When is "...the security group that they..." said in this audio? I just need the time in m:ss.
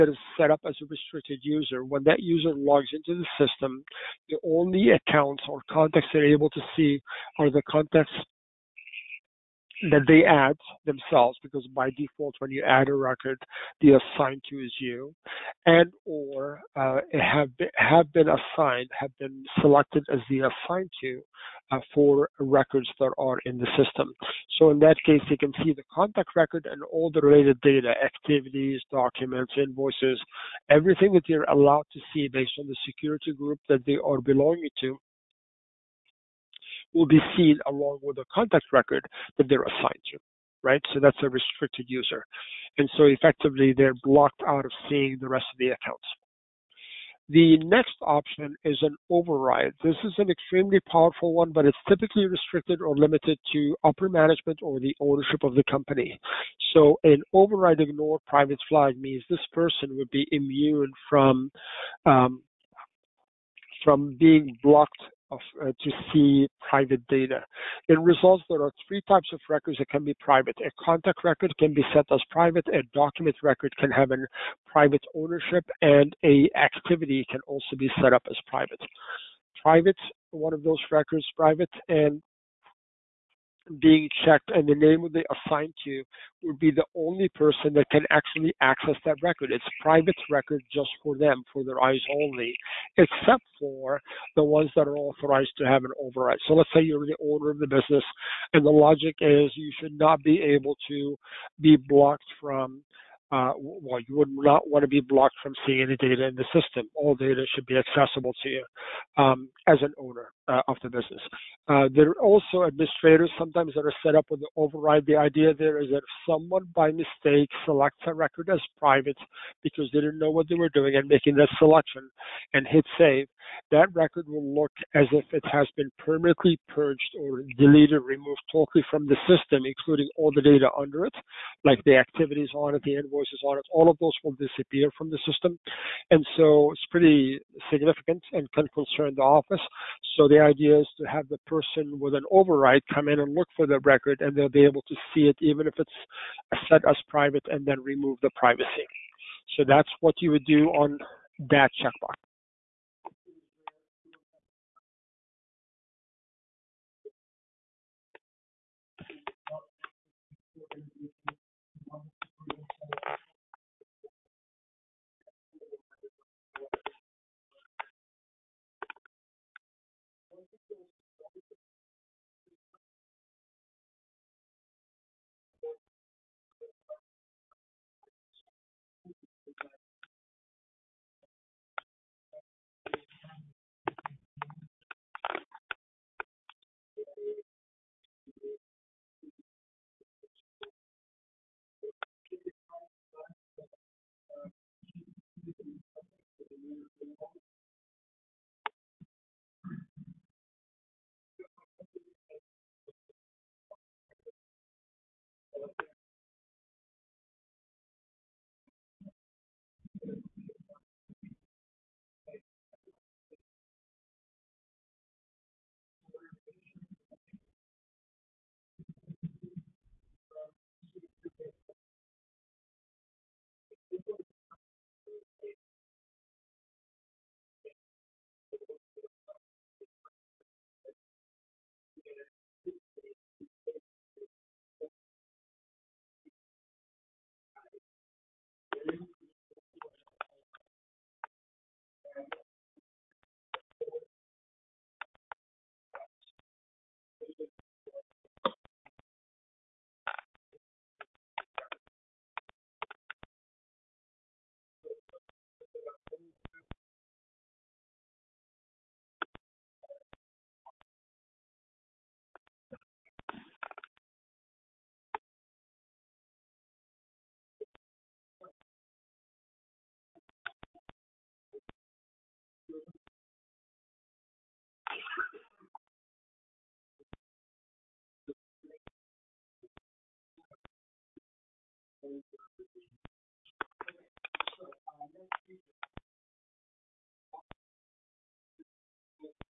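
0:32.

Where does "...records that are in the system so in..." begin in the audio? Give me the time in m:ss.
0:22.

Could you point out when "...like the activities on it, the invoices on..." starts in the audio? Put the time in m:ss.
2:11.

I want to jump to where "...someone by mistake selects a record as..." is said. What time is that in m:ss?
1:56.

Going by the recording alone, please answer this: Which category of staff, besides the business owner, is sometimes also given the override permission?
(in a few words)
administrators.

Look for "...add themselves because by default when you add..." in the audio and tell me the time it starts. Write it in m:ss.
0:10.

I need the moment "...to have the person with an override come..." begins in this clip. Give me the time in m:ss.
2:21.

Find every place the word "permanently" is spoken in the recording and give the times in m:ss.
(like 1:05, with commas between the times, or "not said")
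2:05.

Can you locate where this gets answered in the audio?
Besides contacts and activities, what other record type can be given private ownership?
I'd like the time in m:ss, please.
1:12.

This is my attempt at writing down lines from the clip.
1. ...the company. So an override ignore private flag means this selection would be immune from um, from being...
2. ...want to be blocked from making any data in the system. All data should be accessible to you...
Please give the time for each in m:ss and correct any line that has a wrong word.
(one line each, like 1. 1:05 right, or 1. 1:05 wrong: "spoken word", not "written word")
1. 0:55 wrong: "person", not "selection"
2. 1:44 wrong: "seeing", not "making".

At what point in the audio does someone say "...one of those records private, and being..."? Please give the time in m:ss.
1:20.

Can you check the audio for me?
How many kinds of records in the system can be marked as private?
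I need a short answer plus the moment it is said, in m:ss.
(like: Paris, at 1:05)
3, at 1:08.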